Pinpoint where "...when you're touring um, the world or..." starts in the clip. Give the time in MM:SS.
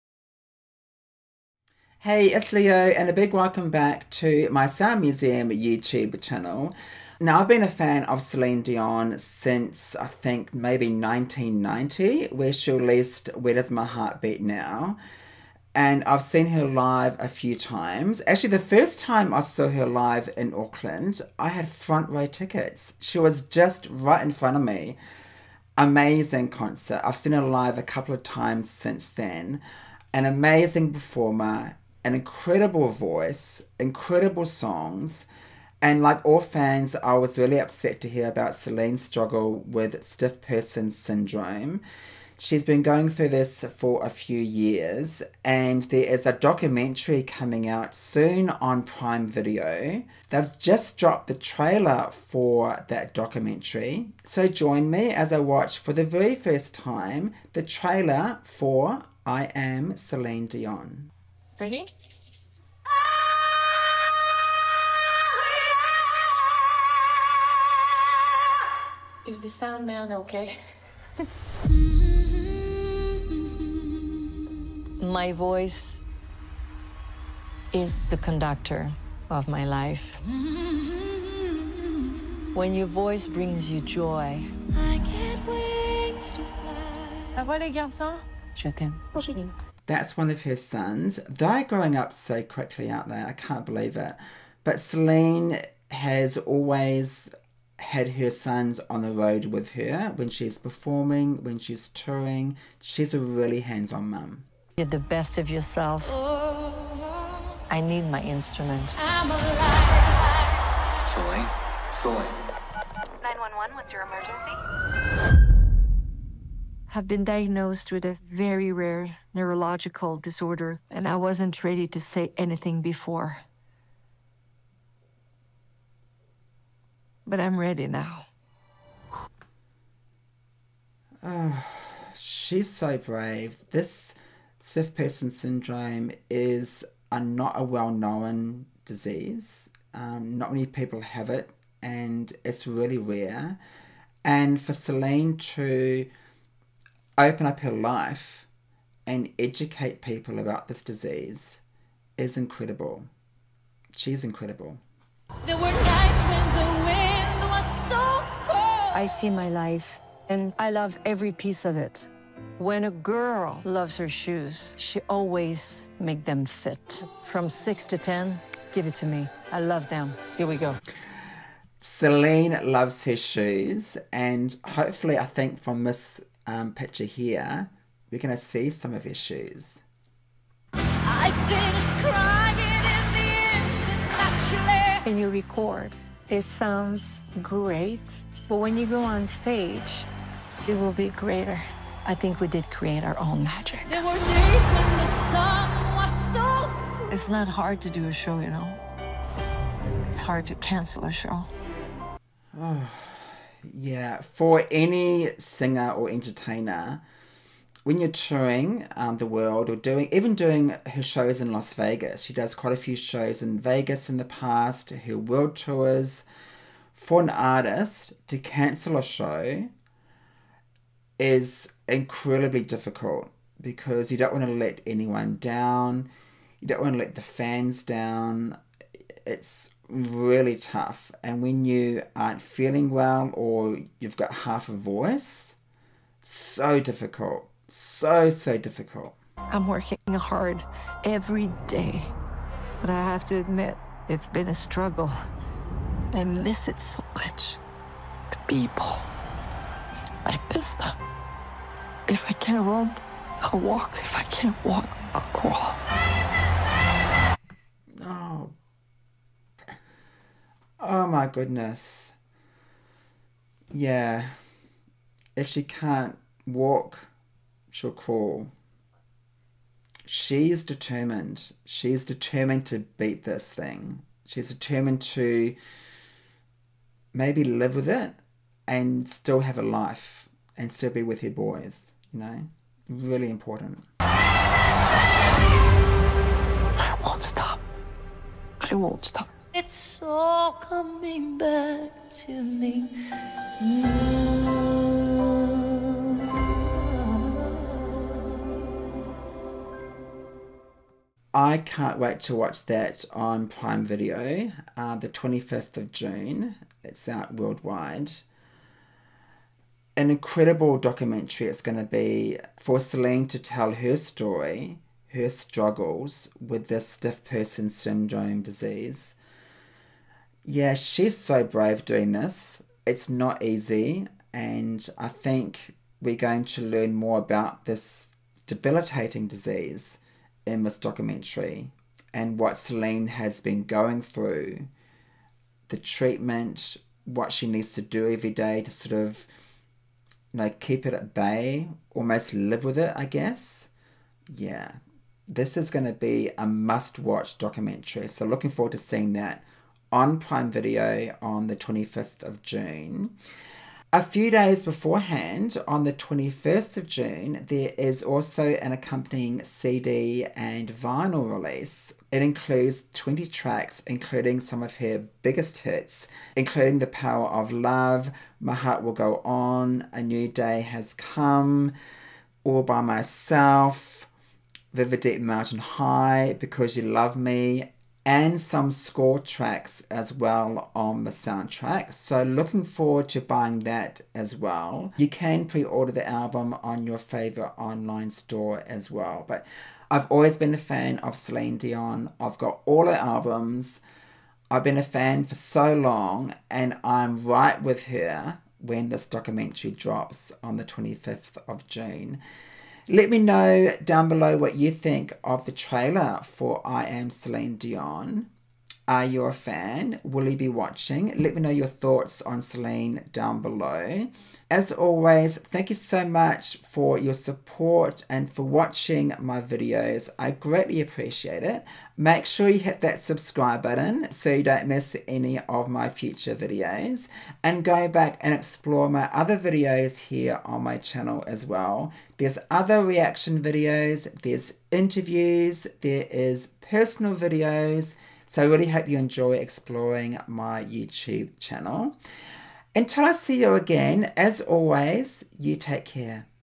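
03:27.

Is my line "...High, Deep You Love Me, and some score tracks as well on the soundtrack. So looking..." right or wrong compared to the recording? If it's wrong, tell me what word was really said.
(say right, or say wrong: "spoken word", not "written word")
wrong: "Because", not "Deep".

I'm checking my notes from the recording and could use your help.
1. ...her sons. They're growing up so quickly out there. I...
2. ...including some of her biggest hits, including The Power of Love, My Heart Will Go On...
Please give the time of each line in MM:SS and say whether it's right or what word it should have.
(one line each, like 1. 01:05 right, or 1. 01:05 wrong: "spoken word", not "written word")
1. 01:30 right
2. 06:03 right.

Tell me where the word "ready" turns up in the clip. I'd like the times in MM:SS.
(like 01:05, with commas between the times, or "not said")
01:01, 02:01, 02:07.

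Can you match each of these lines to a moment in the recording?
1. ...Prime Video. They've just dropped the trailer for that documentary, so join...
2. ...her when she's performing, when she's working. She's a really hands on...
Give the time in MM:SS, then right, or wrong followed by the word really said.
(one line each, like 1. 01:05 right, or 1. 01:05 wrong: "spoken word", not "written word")
1. 00:48 right
2. 01:39 wrong: "touring", not "working".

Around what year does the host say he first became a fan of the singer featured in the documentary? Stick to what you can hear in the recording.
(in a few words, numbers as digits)
1990.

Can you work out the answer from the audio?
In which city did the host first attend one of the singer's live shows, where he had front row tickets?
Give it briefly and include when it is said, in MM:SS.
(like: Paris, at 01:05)
Auckland, at 00:20.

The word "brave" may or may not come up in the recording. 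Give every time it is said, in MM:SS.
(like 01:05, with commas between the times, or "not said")
02:12, 05:21.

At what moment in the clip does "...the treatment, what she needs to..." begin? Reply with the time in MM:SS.
05:35.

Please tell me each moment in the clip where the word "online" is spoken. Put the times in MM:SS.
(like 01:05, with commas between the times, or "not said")
06:27.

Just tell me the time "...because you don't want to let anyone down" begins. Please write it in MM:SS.
03:43.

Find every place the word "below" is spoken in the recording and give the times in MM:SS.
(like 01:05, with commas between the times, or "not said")
06:44, 06:53.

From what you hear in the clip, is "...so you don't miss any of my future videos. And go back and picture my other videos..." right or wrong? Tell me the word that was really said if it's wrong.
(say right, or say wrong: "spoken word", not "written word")
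wrong: "explore", not "picture".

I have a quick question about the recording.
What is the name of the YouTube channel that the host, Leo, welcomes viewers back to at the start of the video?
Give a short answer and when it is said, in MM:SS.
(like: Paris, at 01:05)
Sound Museum, at 00:04.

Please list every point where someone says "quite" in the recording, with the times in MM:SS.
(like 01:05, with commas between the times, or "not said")
03:32.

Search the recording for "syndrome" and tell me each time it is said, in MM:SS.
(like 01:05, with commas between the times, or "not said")
00:40, 02:15, 05:17.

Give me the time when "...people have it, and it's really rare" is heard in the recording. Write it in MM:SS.
02:20.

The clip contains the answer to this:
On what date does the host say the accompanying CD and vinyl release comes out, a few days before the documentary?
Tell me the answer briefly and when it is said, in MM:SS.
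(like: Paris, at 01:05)
21 June, at 05:55.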